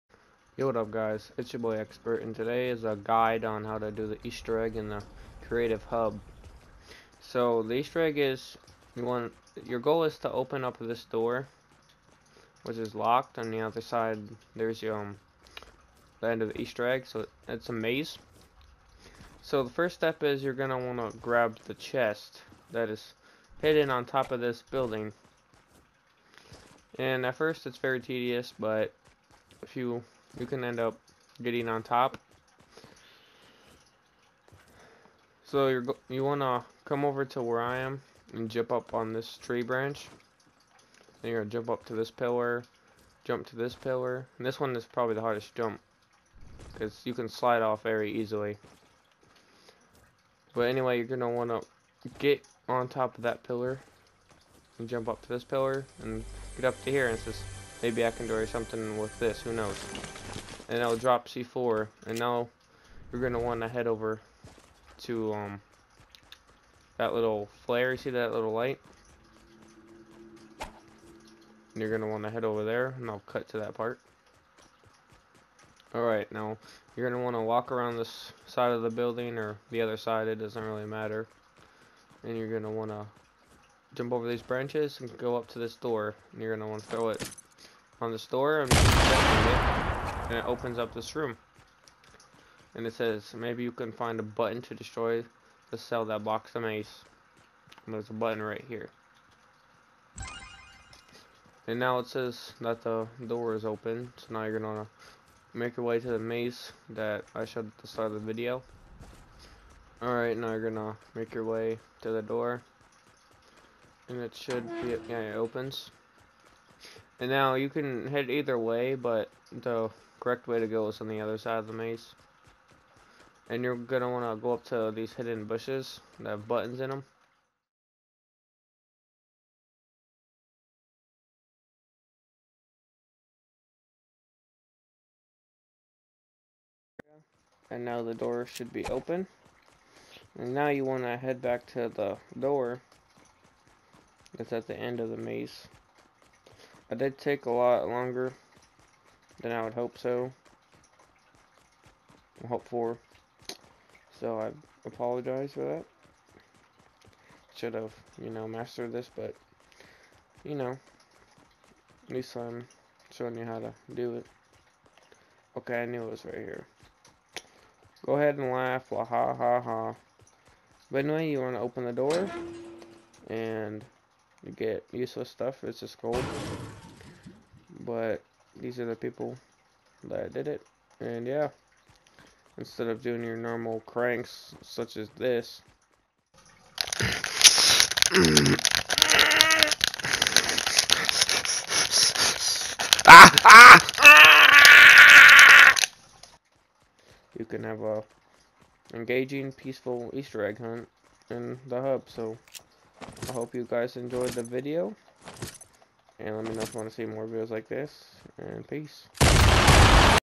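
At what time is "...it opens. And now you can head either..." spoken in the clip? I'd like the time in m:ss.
1:55.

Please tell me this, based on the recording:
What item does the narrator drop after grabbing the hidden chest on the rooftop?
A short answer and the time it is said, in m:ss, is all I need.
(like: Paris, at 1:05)
C4, at 1:01.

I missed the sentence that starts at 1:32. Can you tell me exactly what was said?
And it says, maybe you can find a button to destroy the cell that blocks the maze.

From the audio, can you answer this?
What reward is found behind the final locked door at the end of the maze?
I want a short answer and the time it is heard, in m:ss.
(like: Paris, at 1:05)
gold, at 2:56.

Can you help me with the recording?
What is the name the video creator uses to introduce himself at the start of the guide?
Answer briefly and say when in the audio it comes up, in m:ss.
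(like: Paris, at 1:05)
Xpert, at 0:01.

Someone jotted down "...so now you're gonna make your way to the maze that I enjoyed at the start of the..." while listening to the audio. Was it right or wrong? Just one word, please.
wrong.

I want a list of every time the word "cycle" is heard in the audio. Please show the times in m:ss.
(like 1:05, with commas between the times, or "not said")
not said.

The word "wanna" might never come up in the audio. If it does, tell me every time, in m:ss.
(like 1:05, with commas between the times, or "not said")
0:20, 2:04, 2:20.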